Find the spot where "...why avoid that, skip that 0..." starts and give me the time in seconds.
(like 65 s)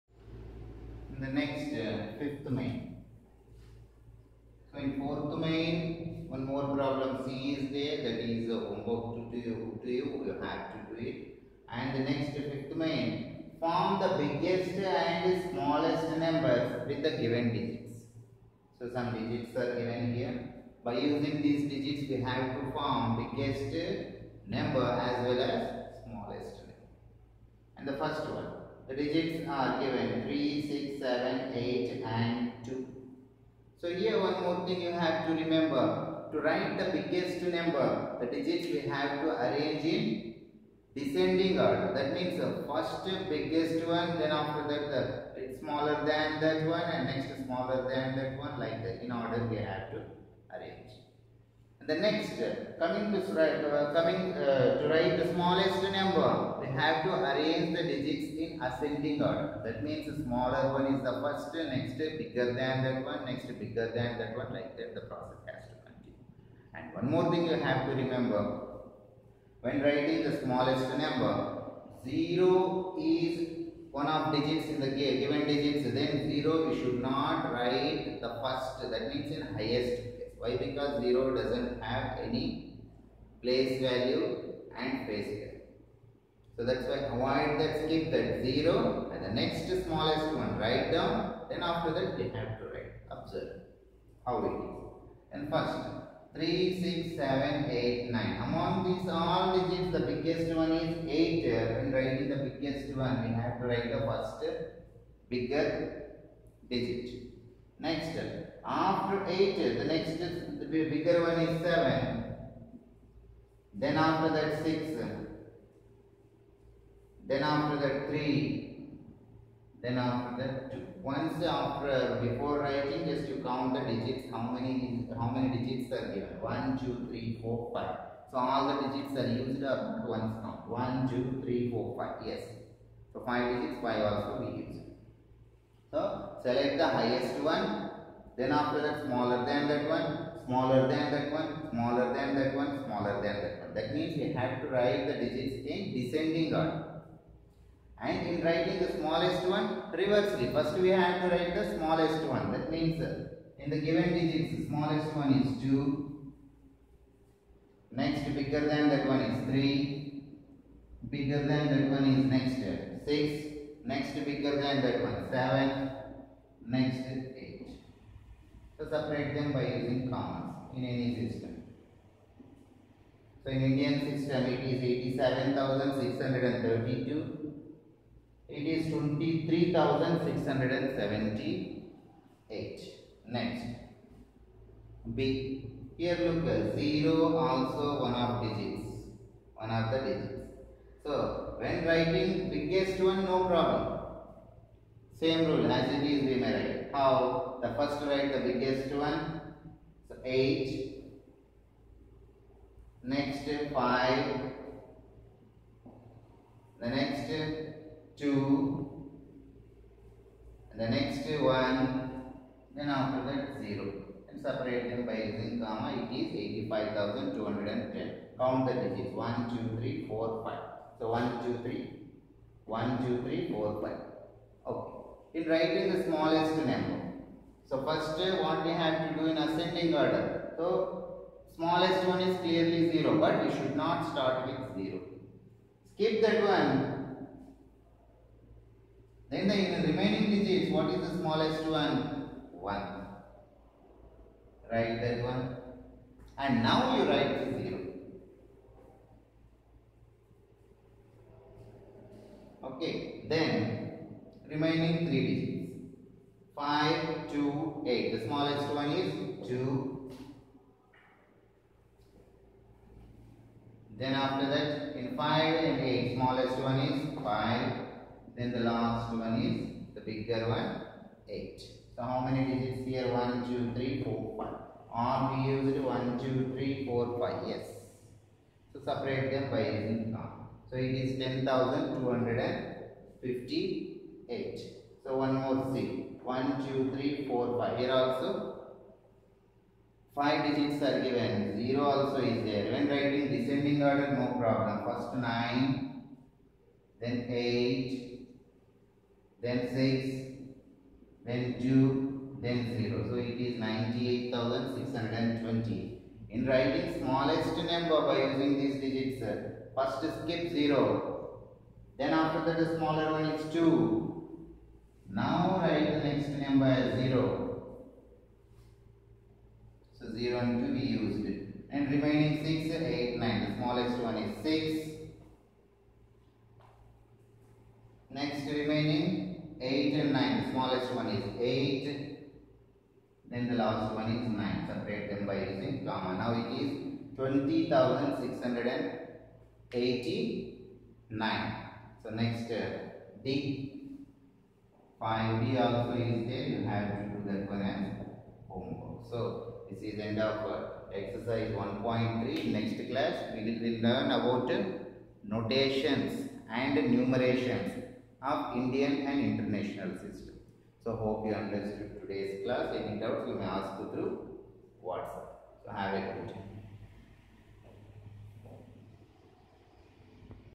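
86 s.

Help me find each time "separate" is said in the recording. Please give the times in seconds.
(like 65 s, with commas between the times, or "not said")
168 s, 214 s, 278 s, 334 s.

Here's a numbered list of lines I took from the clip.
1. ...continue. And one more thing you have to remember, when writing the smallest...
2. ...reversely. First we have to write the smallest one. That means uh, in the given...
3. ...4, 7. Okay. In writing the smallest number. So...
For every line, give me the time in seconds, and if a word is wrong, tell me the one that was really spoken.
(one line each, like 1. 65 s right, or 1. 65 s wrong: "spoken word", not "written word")
1. 65 s right
2. 149 s right
3. 223 s wrong: "5", not "7".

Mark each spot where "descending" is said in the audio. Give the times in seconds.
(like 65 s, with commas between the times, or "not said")
40 s, 145 s, 293 s.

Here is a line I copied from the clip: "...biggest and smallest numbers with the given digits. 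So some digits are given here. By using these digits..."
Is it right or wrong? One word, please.
right.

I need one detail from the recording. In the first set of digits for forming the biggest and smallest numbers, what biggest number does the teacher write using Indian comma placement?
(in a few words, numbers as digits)
87,632.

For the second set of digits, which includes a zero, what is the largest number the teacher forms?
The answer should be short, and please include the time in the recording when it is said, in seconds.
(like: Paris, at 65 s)
85,210, at 216 s.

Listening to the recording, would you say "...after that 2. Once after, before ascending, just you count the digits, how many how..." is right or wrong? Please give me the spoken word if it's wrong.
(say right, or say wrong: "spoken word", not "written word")
wrong: "writing", not "ascending".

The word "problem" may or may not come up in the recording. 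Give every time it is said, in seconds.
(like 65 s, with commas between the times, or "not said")
6 s, 193 s, 294 s.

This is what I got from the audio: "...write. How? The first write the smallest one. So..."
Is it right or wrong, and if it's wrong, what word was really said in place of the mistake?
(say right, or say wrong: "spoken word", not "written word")
wrong: "biggest", not "smallest".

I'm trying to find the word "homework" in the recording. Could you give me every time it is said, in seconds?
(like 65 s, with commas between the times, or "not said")
8 s, 348 s.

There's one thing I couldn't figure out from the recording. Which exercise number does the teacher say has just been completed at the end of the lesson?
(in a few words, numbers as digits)
1.3.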